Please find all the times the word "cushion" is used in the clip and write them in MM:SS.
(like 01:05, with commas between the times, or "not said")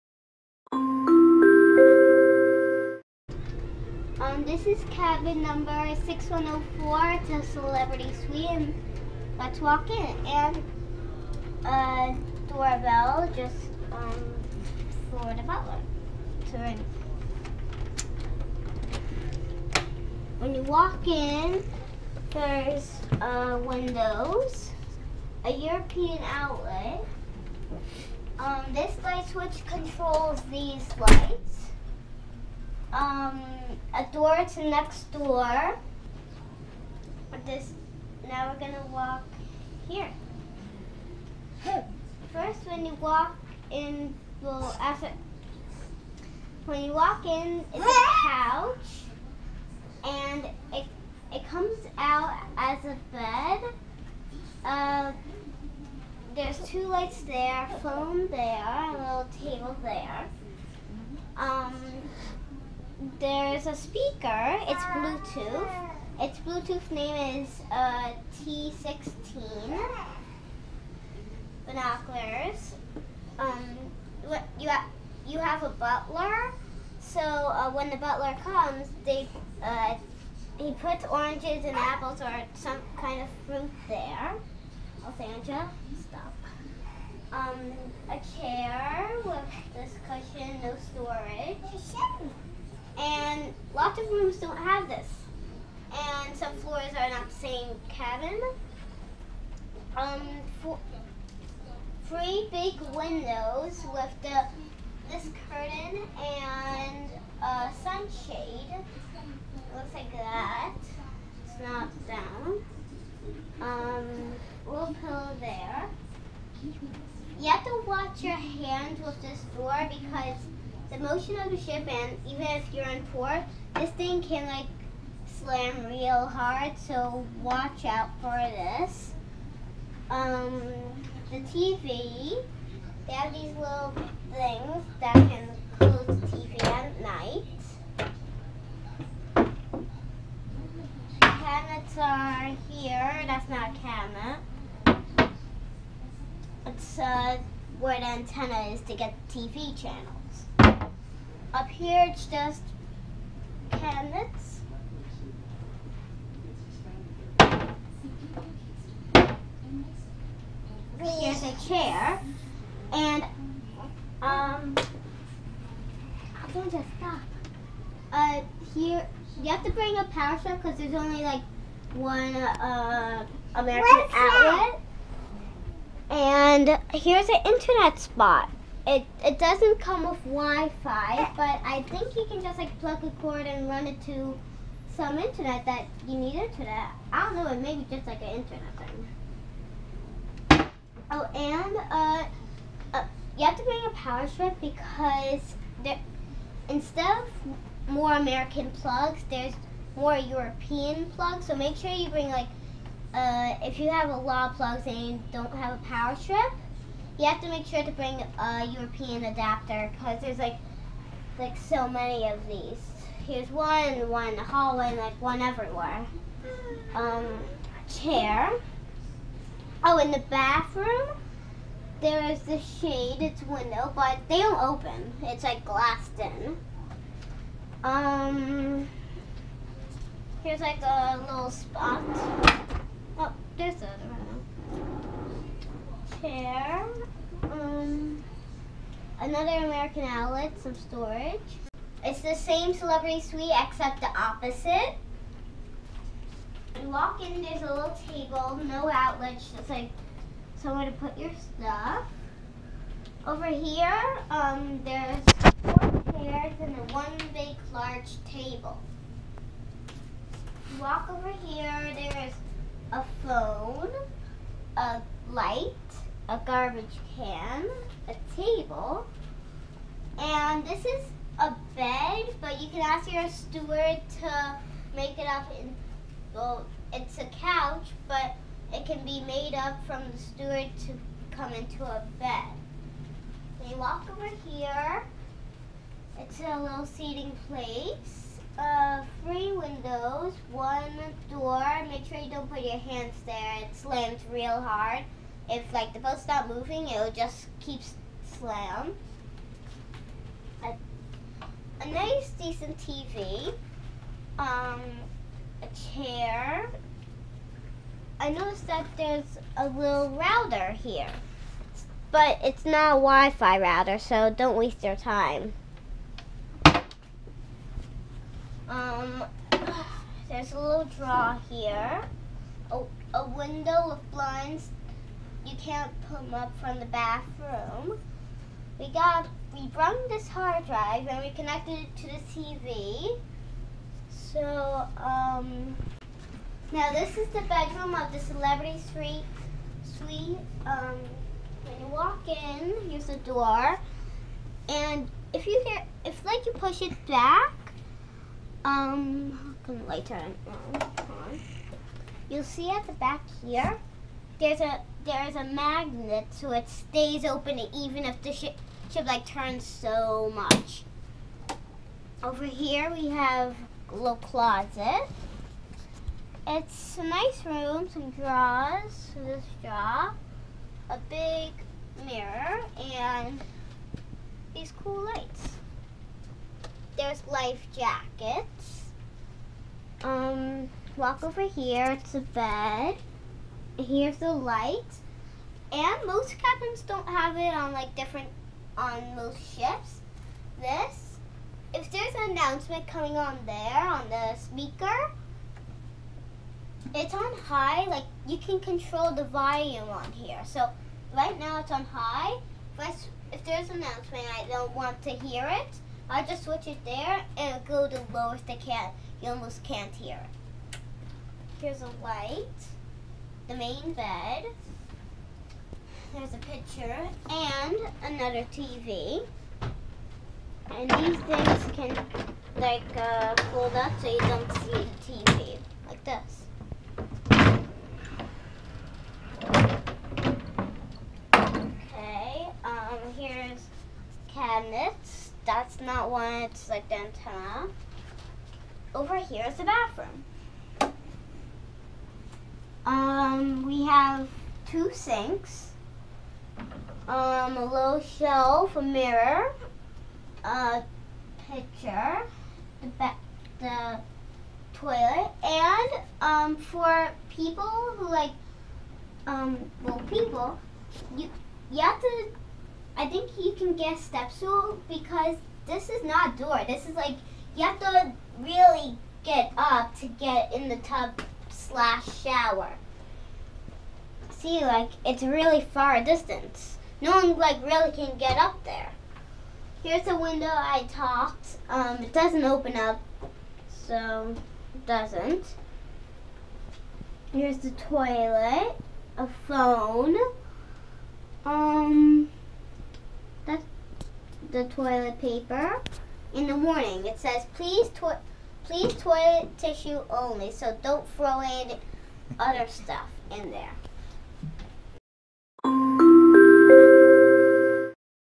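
01:30.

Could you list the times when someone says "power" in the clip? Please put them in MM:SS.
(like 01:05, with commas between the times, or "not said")
02:50, 03:13, 03:25.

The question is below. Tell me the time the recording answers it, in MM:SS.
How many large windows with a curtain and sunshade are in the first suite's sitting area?
01:42.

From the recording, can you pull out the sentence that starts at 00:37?
This now we're gonna walk here.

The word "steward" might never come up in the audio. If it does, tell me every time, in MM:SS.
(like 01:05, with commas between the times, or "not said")
04:33, 04:40.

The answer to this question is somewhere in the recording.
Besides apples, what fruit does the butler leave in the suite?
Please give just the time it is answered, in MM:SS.
01:21.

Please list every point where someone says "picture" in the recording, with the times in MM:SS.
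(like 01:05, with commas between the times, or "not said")
06:56, 07:31.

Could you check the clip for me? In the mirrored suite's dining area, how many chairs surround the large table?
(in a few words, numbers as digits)
4.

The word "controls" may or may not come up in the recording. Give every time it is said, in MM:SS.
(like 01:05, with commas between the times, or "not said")
00:29, 06:38.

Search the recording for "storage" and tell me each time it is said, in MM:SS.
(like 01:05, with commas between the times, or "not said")
01:30, 04:00.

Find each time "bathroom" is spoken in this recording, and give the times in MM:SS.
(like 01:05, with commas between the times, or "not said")
03:40, 05:26, 07:19.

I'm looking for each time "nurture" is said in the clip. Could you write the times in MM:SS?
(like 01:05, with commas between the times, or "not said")
not said.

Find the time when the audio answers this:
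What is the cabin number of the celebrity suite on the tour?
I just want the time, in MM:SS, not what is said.
00:06.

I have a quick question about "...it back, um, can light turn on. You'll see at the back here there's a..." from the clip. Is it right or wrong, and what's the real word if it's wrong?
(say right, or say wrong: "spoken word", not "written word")
right.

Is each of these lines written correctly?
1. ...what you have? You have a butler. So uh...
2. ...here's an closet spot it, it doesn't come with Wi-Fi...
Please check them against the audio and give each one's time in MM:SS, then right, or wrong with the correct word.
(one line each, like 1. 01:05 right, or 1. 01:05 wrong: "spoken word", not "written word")
1. 01:14 right
2. 02:56 wrong: "internet", not "closet".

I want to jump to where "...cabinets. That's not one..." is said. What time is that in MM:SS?
07:14.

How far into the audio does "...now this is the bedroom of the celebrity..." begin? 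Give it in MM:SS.
05:36.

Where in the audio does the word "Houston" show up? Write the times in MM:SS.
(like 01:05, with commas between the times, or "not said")
not said.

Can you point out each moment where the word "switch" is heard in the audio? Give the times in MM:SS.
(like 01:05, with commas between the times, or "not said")
00:29, 06:46.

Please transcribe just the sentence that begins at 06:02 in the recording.
Over here we have a little closet.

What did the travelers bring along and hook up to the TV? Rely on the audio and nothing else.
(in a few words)
hard drive.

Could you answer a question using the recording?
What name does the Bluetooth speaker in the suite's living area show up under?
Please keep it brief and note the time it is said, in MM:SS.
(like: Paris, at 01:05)
T16, at 01:08.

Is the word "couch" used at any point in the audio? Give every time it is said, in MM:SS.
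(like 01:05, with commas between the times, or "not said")
00:48, 04:37.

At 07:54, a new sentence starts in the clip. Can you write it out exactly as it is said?
See, like, it's really far distance.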